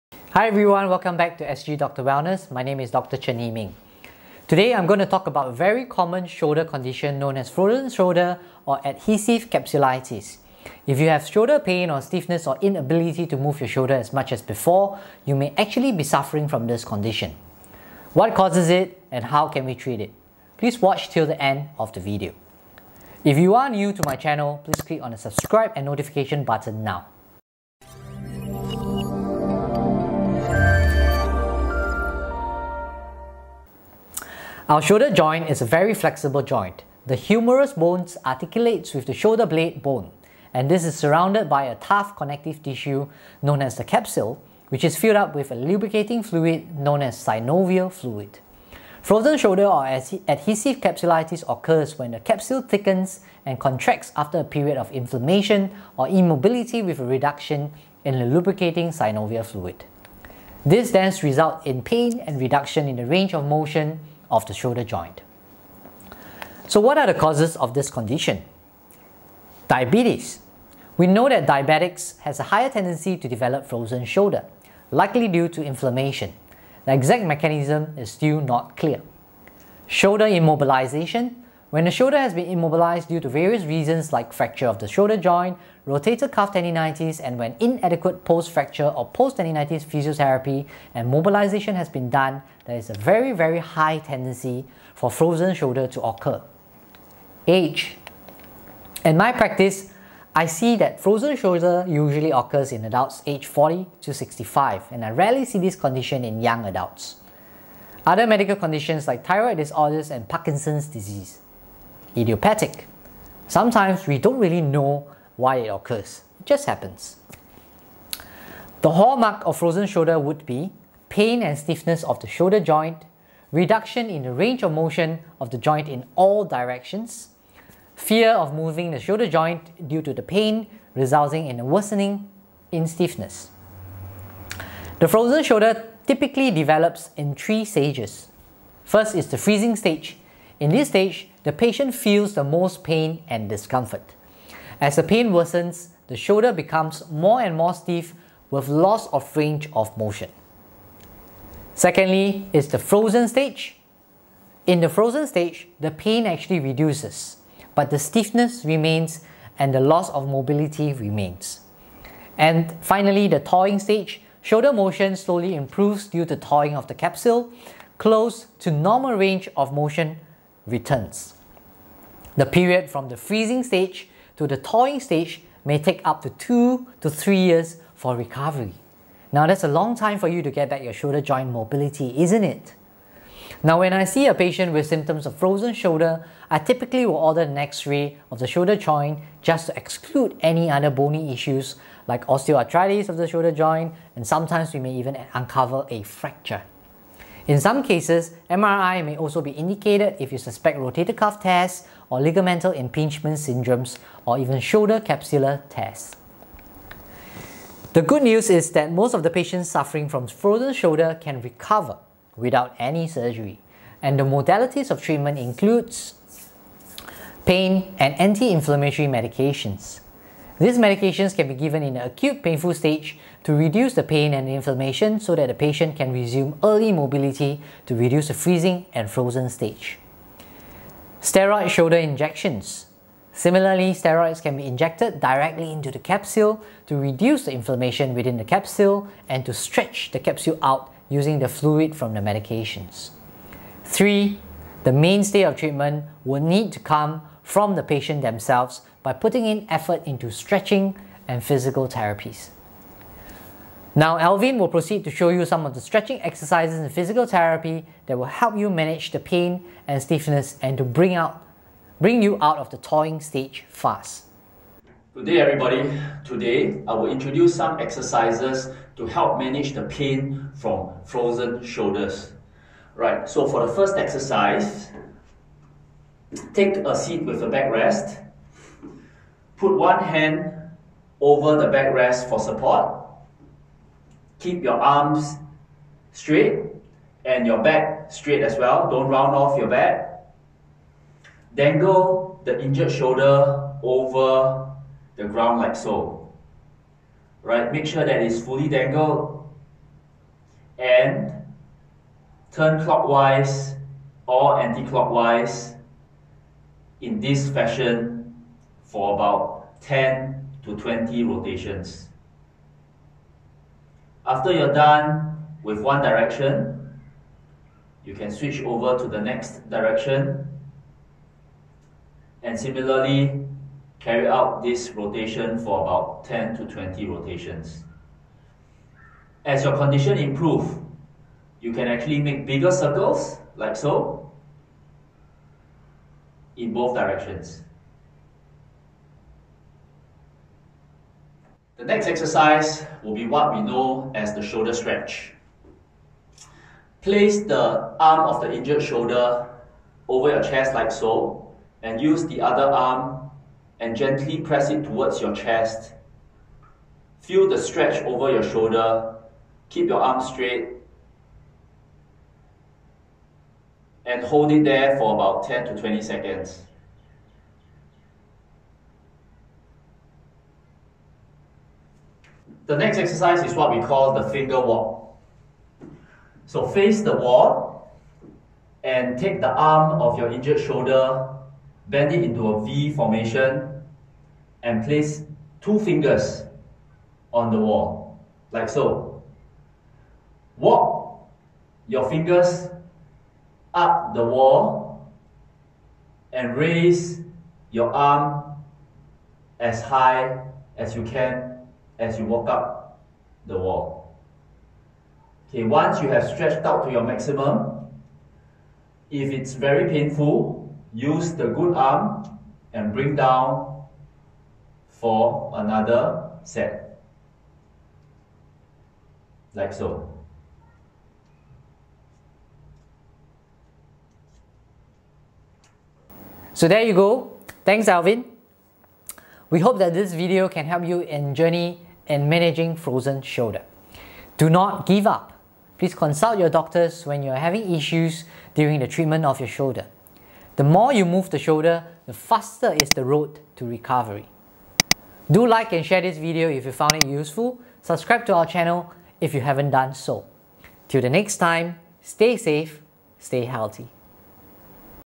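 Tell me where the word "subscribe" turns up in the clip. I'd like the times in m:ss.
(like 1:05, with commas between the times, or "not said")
0:25, 7:27.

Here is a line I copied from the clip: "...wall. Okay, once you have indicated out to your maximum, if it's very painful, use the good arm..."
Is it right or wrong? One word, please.
wrong.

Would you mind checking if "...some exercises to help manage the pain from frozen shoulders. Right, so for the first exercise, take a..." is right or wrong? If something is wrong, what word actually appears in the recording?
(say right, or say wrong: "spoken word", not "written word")
right.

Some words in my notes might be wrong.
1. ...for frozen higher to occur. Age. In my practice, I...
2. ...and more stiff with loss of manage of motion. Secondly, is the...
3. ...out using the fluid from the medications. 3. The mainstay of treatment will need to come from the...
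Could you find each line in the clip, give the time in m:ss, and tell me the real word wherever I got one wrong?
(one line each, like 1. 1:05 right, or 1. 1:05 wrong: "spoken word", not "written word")
1. 1:34 wrong: "shoulder", not "higher"
2. 2:27 wrong: "range", not "manage"
3. 4:00 right.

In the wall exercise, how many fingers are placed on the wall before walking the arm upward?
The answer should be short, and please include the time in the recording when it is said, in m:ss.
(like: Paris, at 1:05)
2, at 6:25.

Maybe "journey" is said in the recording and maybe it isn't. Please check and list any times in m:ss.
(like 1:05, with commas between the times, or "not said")
7:11.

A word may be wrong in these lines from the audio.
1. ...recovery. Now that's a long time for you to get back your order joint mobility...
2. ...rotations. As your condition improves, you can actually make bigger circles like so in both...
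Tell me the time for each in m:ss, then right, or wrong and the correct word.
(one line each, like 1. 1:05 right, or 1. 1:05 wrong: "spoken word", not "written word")
1. 2:58 wrong: "shoulder", not "order"
2. 5:27 right.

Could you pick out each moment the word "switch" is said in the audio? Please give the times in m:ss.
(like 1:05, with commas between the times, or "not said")
5:18.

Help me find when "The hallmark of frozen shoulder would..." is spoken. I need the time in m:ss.
1:58.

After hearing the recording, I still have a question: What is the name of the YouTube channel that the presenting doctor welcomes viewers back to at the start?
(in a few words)
SG Doctor Wellness.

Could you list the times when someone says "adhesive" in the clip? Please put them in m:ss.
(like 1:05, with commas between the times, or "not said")
0:08, 0:49.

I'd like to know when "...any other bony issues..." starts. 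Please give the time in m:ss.
3:10.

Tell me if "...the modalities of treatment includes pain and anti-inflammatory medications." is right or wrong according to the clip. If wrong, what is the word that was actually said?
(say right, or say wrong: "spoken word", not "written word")
right.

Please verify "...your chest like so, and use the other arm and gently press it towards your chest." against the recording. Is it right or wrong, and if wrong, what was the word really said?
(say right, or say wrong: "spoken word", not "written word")
right.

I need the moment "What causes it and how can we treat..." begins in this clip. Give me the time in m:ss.
0:18.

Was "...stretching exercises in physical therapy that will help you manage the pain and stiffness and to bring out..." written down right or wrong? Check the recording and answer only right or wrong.
right.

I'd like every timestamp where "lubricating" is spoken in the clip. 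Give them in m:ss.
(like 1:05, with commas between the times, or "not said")
0:45, 0:58.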